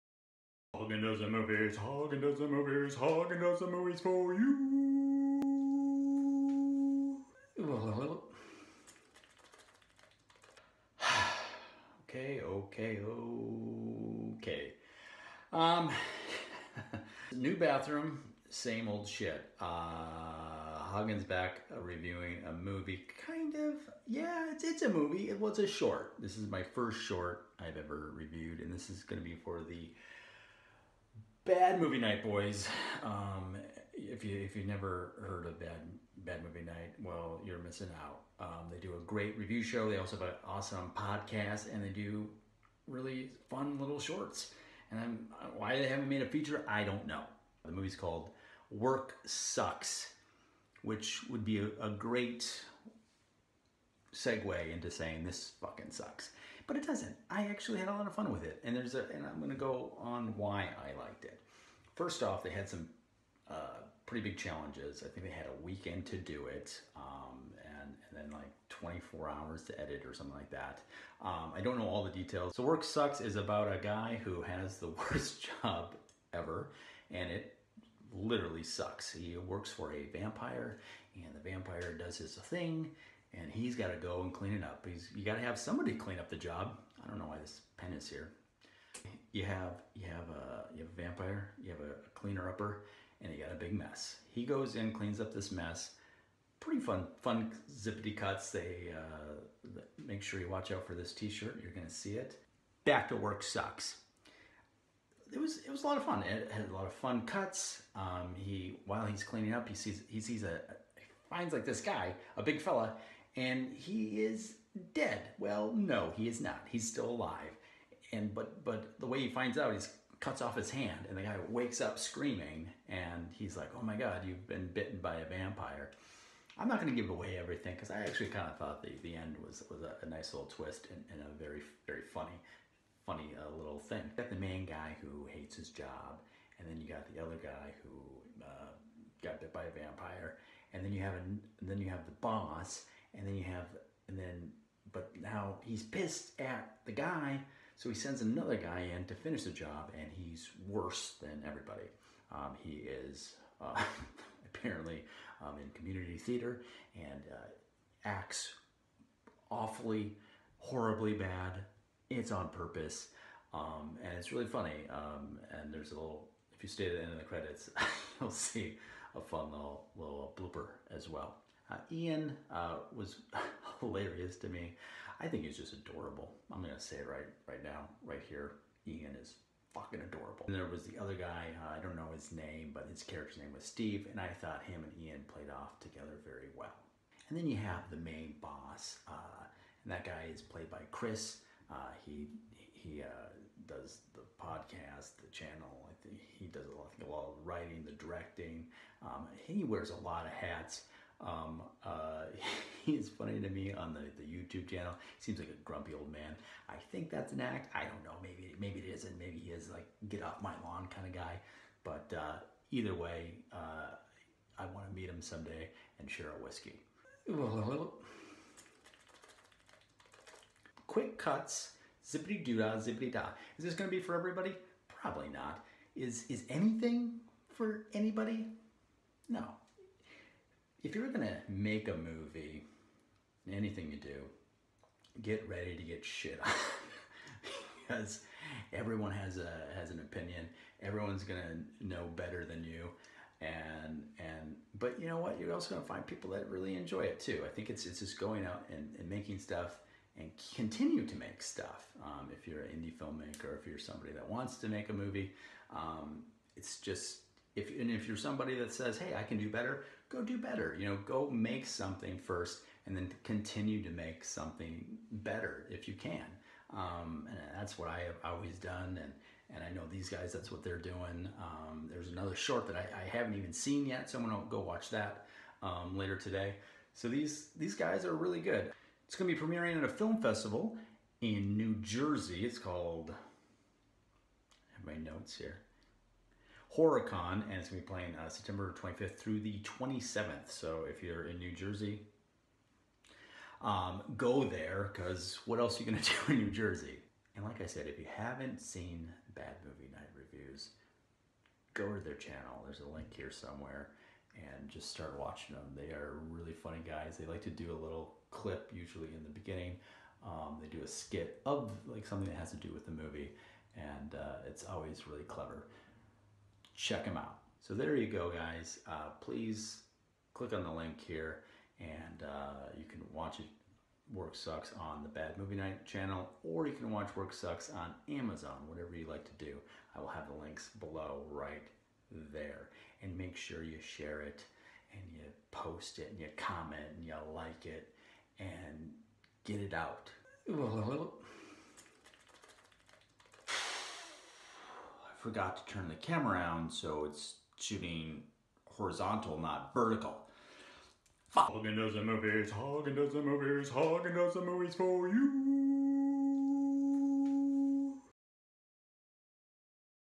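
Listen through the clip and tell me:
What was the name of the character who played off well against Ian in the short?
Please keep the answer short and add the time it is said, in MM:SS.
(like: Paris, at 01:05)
Steve, at 03:03.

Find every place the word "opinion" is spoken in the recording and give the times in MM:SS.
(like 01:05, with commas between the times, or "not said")
03:59.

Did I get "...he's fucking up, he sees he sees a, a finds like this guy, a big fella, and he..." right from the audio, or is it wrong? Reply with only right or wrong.
wrong.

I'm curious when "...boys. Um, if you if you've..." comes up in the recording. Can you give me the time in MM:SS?
00:32.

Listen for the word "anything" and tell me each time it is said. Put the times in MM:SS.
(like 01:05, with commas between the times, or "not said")
03:46, 03:53.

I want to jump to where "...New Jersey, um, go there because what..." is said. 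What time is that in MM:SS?
04:51.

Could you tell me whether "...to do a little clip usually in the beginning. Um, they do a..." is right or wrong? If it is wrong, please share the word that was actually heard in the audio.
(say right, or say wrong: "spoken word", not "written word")
right.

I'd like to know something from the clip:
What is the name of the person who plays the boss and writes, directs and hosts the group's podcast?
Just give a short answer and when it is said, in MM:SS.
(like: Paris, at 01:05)
Chris, at 03:10.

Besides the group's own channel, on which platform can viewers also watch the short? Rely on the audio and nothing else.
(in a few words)
Amazon.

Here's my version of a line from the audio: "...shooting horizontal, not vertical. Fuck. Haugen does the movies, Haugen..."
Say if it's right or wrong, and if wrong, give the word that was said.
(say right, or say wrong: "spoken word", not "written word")
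right.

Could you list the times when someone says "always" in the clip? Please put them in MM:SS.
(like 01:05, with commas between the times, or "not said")
04:28, 05:14.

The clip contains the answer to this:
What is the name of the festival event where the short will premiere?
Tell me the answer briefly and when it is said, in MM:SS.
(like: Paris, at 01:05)
HorrorCon, at 04:46.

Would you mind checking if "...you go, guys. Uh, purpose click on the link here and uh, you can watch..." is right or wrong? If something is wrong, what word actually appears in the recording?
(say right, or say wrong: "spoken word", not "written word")
wrong: "please", not "purpose".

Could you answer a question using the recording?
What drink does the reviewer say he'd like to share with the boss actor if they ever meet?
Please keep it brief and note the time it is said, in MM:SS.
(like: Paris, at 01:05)
whiskey, at 03:36.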